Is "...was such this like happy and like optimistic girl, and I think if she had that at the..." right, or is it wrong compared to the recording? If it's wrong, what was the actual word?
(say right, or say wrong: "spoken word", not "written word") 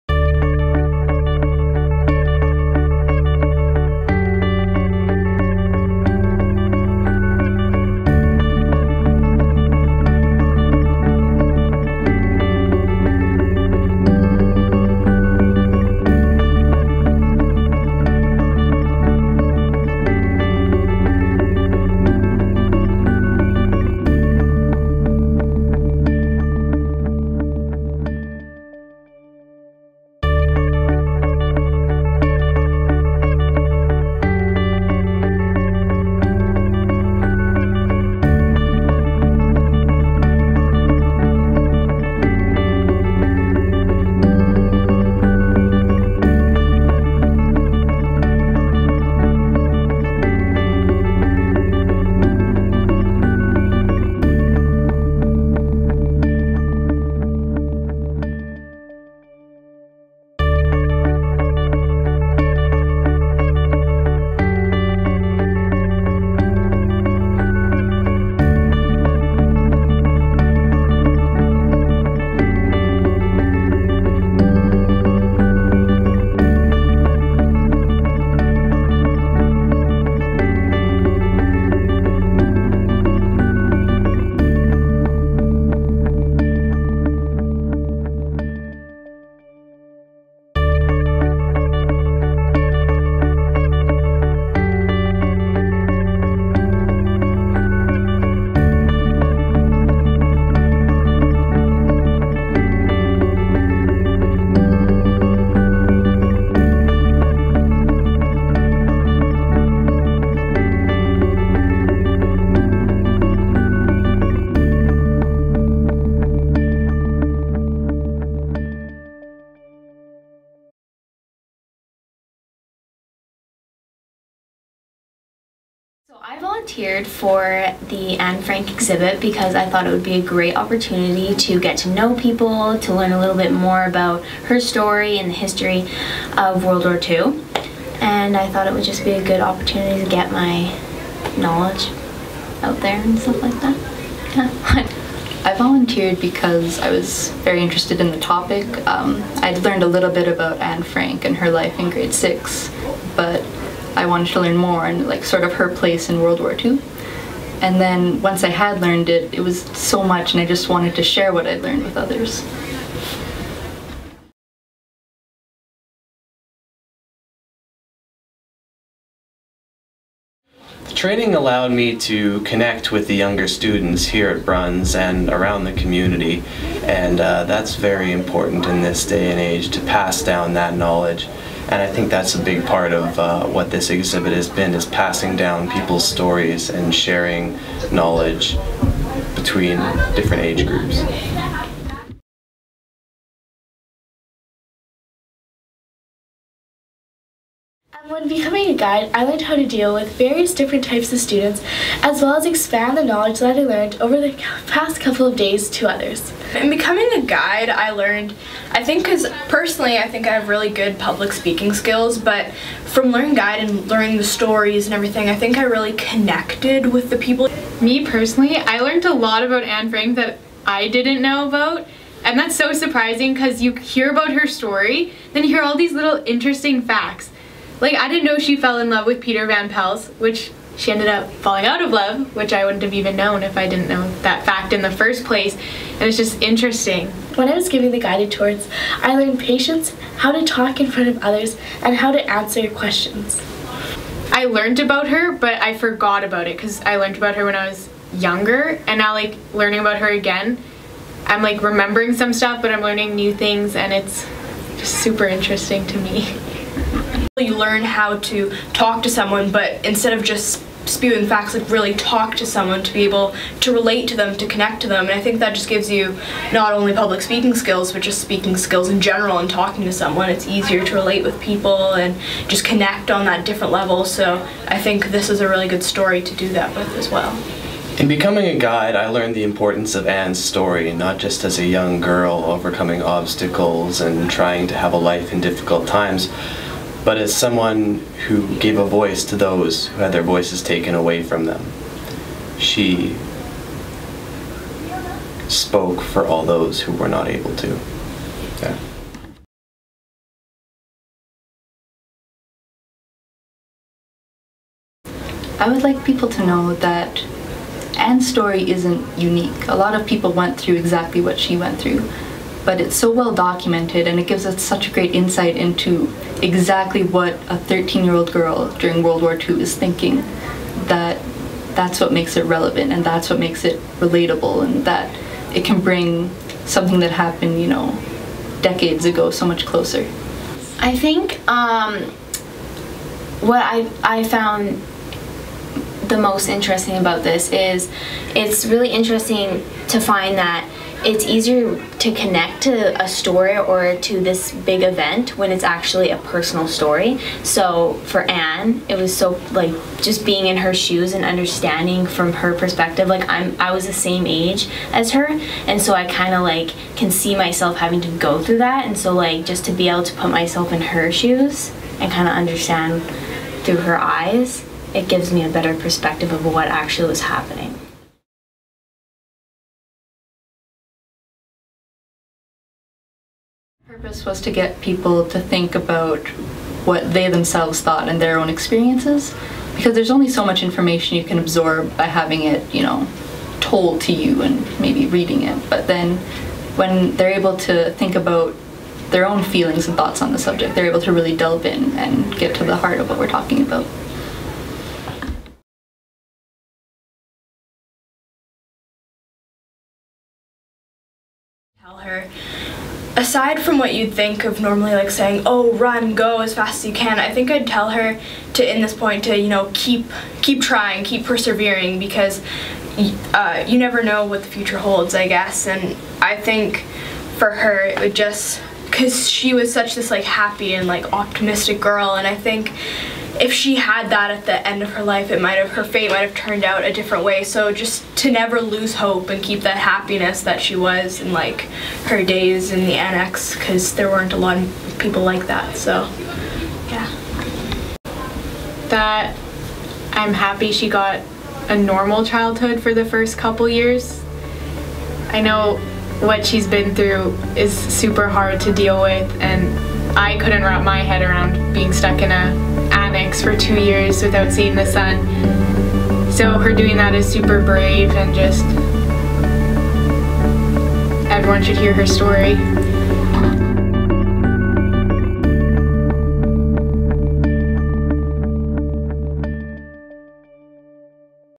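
right.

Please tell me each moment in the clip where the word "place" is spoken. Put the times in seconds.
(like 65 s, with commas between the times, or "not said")
155 s, 235 s.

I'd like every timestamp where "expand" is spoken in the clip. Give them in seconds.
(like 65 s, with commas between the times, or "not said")
202 s.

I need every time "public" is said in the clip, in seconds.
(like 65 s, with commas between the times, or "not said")
210 s, 266 s.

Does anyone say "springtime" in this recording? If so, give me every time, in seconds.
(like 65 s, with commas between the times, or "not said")
not said.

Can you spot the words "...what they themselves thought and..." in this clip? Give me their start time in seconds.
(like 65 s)
376 s.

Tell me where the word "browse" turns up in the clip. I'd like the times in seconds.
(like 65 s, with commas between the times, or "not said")
not said.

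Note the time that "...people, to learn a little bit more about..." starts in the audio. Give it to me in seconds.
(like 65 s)
132 s.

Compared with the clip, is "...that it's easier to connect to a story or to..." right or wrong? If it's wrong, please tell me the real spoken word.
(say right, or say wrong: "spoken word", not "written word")
right.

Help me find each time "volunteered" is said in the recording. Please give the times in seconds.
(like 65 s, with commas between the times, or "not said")
126 s, 145 s.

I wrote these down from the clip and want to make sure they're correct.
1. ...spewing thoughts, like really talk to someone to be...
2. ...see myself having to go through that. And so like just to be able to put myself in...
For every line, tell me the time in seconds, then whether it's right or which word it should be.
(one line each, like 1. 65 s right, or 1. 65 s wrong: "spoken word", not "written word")
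1. 260 s wrong: "facts", not "thoughts"
2. 357 s right.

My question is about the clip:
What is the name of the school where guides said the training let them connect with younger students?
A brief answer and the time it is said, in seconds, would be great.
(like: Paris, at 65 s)
Bruns, at 174 s.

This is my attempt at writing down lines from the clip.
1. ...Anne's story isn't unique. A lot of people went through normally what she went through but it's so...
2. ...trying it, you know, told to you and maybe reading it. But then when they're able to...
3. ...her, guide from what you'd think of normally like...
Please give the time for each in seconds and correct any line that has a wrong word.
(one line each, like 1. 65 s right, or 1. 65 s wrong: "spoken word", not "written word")
1. 307 s wrong: "exactly", not "normally"
2. 382 s wrong: "having", not "trying"
3. 401 s wrong: "aside", not "guide".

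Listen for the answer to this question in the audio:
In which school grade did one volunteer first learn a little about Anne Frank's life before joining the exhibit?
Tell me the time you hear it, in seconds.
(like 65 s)
151 s.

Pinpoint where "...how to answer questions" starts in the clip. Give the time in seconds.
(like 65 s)
241 s.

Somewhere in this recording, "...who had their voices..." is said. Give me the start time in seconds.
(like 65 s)
289 s.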